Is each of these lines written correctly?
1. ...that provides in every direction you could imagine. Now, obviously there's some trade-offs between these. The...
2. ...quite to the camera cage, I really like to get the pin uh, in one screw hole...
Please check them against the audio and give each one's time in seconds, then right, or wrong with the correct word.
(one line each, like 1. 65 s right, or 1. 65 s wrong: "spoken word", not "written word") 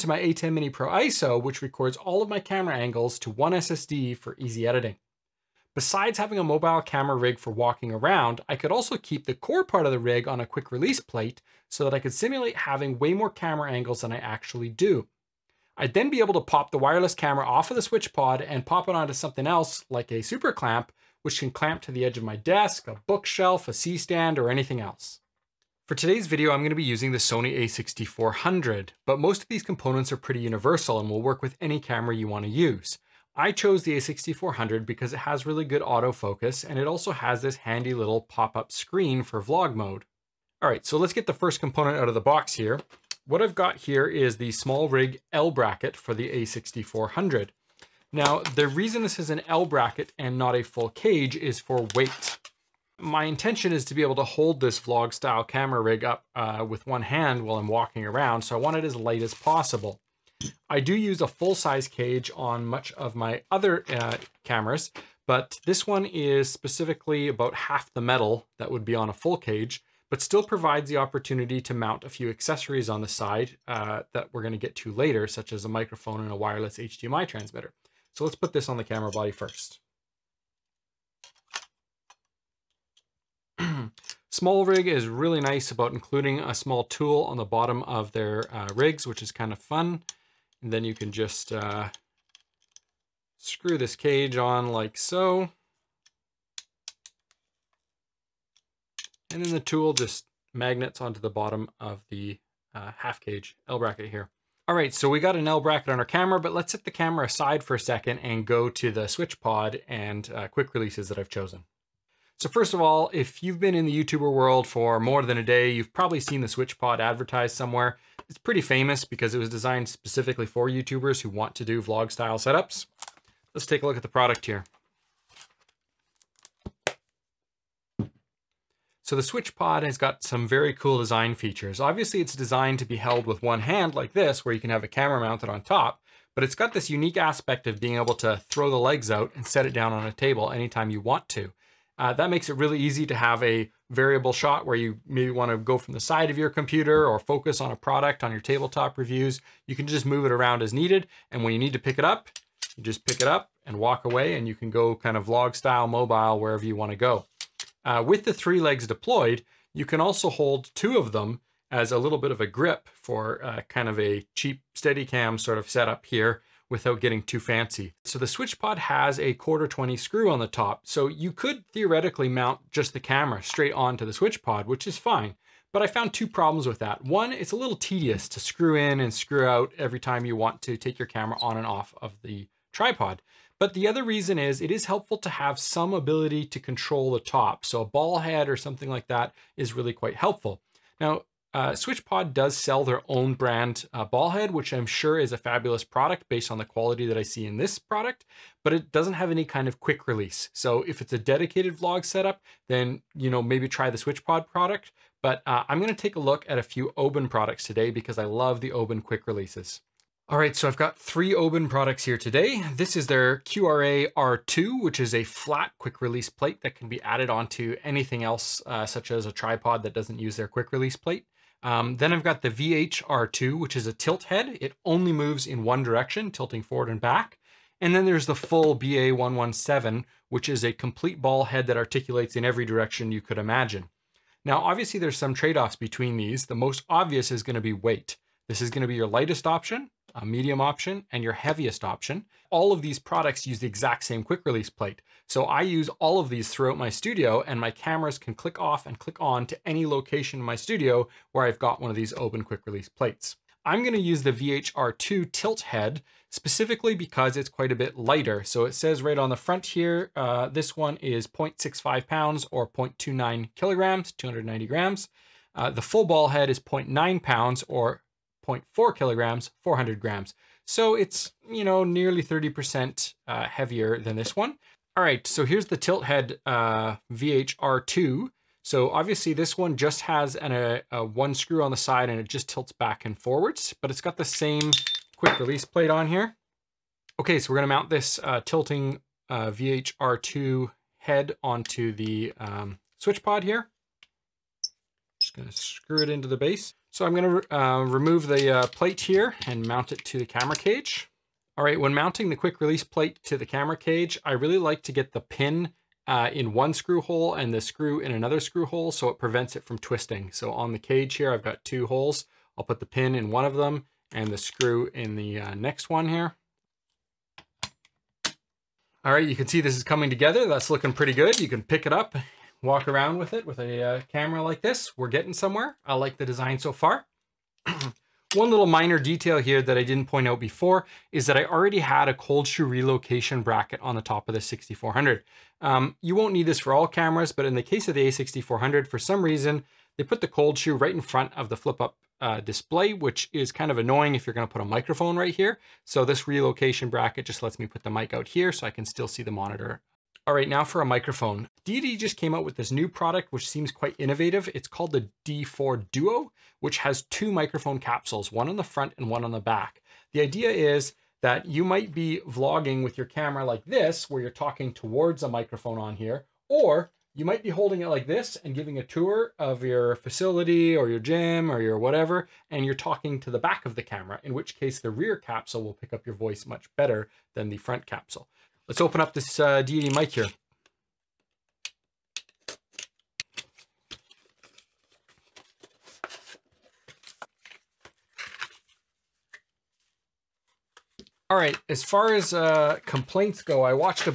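1. 231 s wrong: "articulates", not "provides"
2. 302 s wrong: "plate", not "quite".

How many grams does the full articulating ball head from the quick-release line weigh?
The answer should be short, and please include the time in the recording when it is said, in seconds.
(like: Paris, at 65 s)
400 grams, at 269 s.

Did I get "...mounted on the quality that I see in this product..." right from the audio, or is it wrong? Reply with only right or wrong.
wrong.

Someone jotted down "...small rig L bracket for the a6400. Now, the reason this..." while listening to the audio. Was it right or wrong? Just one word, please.
right.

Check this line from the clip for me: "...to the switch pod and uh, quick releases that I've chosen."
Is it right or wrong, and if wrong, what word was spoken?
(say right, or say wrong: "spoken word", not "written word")
right.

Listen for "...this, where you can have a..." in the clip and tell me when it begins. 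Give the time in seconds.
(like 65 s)
134 s.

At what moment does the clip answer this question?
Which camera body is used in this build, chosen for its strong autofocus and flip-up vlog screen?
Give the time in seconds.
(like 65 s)
27 s.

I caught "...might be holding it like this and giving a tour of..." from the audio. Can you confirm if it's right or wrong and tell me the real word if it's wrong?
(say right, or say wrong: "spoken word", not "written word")
right.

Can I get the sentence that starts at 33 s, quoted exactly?
I chose the a6400 because it has really good autofocus and it also has this handy little pop-up screen for vlog mode.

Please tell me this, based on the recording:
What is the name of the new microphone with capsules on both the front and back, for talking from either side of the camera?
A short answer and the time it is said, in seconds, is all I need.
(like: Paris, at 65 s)
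D4 Duo, at 355 s.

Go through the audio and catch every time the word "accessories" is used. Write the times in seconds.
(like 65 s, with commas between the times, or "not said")
72 s.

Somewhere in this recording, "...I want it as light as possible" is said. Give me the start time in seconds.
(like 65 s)
58 s.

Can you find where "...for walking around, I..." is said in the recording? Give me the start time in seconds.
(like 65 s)
7 s.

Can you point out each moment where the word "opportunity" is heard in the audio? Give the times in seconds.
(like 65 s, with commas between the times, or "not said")
70 s.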